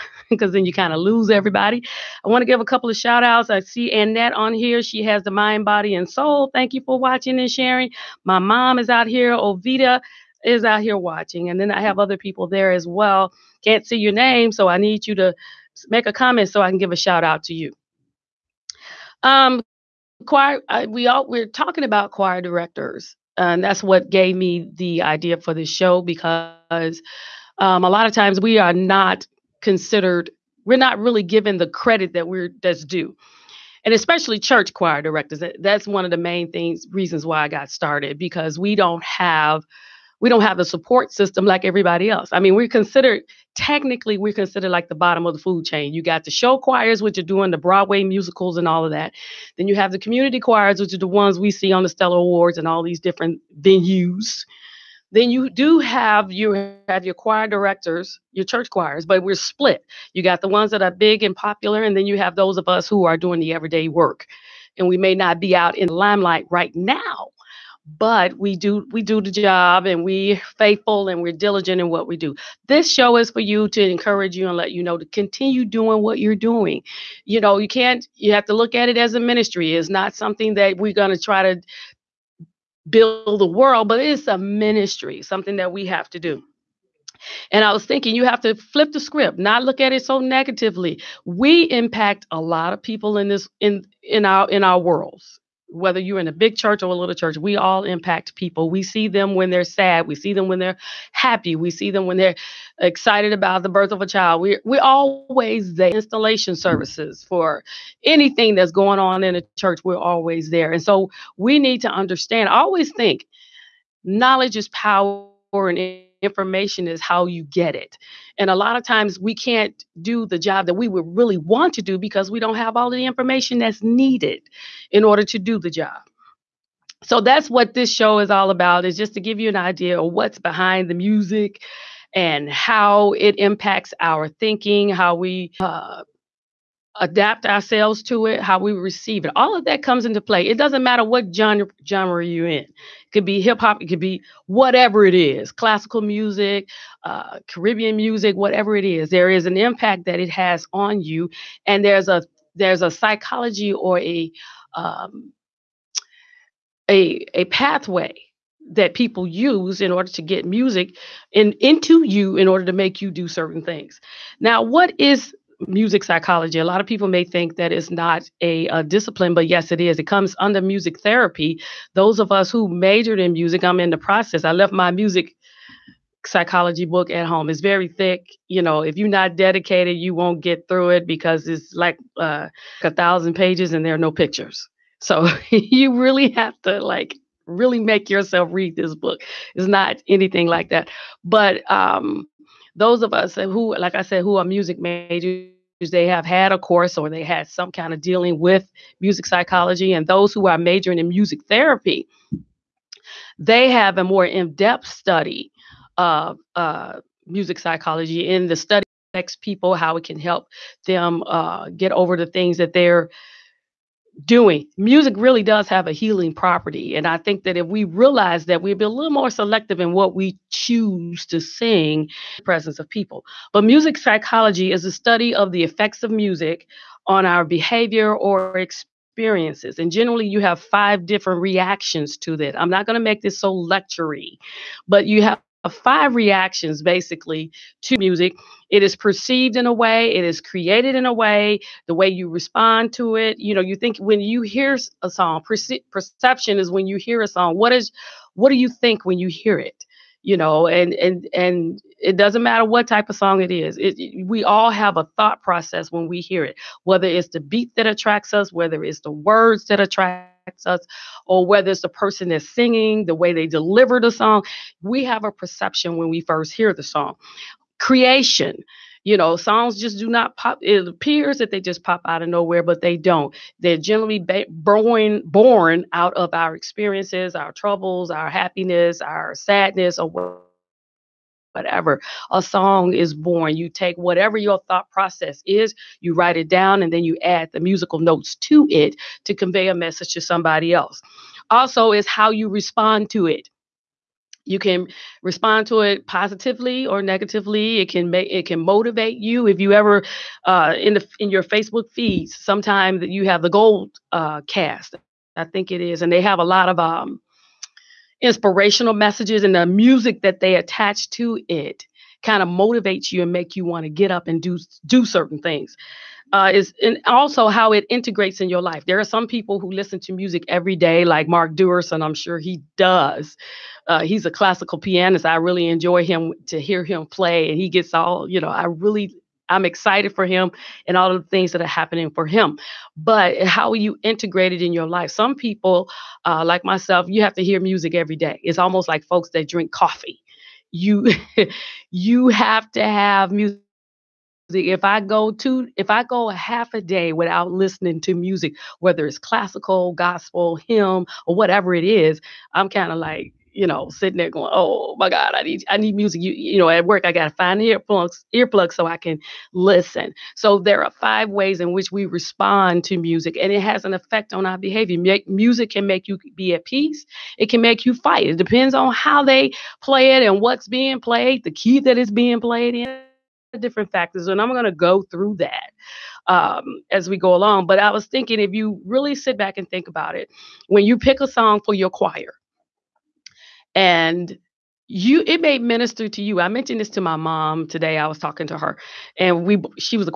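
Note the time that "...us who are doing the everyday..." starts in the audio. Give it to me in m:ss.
1:02.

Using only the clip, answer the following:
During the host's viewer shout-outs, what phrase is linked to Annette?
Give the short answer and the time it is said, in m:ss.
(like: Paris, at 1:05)
mind, body, and soul, at 0:05.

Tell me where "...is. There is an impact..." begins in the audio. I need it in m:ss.
2:28.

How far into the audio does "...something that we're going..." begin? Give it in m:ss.
1:20.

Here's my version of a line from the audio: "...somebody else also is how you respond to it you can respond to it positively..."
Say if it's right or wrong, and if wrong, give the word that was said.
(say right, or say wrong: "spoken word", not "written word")
right.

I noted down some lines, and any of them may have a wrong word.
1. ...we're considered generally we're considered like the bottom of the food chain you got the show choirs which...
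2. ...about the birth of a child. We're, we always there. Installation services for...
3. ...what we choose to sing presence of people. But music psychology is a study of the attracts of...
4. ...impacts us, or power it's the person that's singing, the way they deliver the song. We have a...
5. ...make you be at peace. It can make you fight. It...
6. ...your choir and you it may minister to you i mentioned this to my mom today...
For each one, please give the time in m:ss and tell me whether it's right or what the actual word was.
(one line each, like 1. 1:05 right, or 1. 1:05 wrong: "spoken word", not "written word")
1. 0:42 wrong: "technically", not "generally"
2. 1:43 right
3. 3:39 wrong: "effects", not "attracts"
4. 4:20 wrong: "whether", not "power"
5. 6:05 right
6. 6:21 right.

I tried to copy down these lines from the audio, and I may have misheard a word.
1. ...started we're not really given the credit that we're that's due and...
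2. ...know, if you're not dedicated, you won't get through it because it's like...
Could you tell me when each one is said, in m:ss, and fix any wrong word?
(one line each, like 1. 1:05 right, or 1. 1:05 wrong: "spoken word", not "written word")
1. 0:29 wrong: "considered", not "started"
2. 2:58 right.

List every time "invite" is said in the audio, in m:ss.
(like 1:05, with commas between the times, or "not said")
not said.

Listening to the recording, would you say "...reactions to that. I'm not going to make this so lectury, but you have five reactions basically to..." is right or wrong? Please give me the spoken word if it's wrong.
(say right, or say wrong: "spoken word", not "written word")
right.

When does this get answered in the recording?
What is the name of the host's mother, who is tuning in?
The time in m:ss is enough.
0:09.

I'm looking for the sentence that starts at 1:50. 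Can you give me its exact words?
And so we need to understand, I always think knowledge is power and information is how you get it.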